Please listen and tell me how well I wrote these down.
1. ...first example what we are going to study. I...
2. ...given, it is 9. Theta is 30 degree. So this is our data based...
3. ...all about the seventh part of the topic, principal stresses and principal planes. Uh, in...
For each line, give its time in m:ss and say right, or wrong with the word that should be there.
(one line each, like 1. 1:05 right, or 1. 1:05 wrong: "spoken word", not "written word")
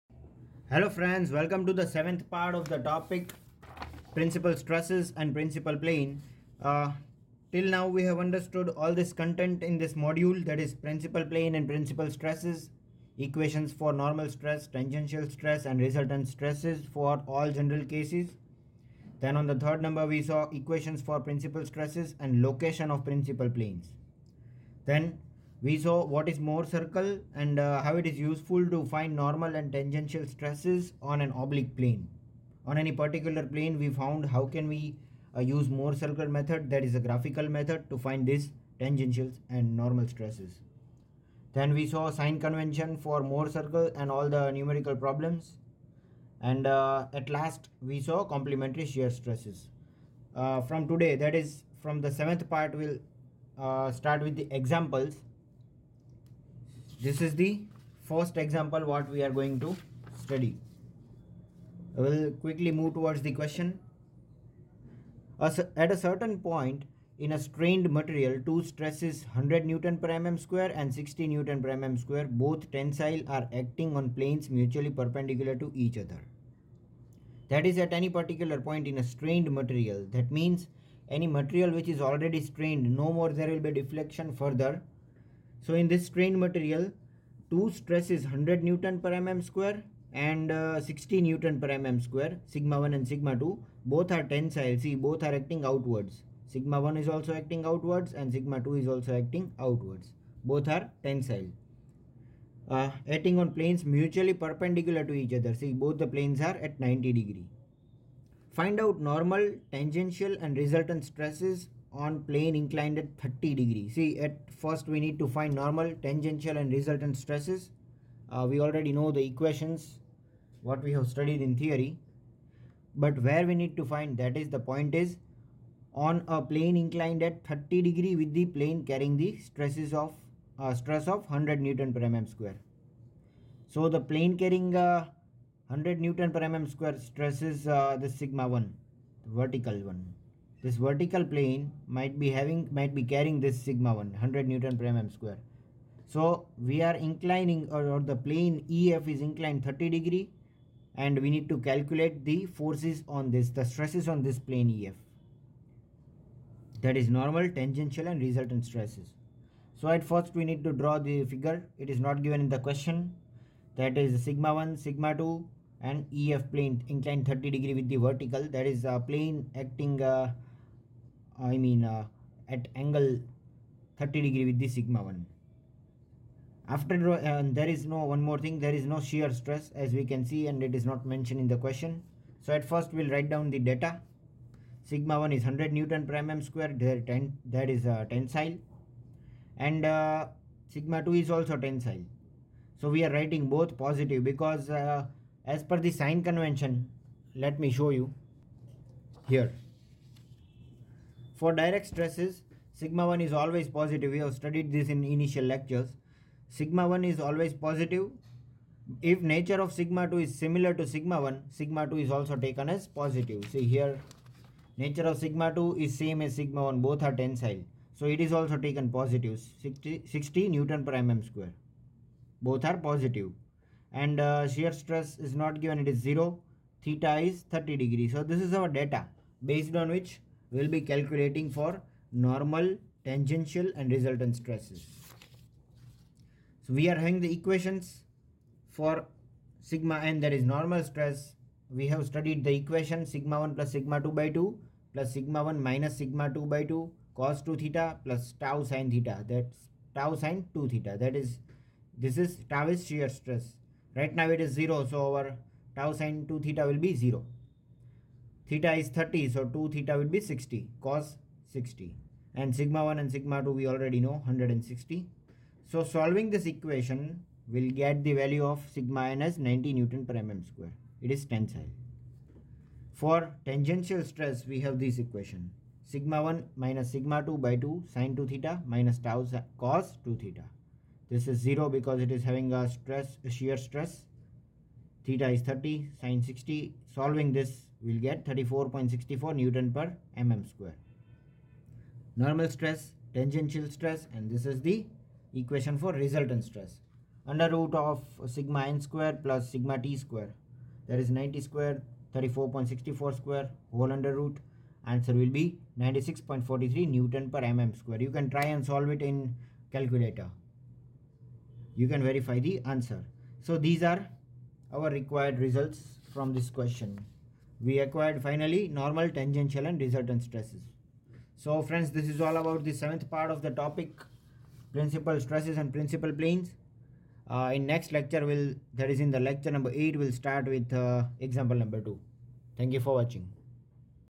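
1. 0:58 right
2. 3:45 wrong: "0", not "9"
3. 5:22 right.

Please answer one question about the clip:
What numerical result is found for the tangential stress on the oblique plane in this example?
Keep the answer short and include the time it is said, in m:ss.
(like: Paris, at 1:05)
34.64 N/mm², at 4:48.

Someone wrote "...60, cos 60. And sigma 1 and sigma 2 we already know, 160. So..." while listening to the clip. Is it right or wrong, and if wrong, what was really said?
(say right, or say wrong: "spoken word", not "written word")
right.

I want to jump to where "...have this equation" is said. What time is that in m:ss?
4:34.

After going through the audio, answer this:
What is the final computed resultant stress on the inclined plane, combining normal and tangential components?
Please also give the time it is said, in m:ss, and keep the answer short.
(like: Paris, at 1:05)
96.43 N/mm², at 5:05.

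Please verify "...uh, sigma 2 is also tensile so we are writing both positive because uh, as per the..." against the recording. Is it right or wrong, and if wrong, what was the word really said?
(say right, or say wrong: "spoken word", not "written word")
right.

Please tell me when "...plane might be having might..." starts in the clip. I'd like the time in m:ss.
2:21.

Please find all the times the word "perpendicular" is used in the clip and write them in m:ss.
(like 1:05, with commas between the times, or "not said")
1:14, 1:44.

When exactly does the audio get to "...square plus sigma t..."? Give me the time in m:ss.
4:58.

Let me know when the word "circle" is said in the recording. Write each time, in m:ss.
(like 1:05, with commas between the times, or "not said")
0:26, 0:35, 0:43.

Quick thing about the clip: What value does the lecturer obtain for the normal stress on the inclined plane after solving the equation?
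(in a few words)
90 N/mm².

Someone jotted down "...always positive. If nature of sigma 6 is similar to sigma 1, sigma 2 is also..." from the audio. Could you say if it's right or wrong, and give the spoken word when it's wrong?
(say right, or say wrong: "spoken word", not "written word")
wrong: "2", not "6".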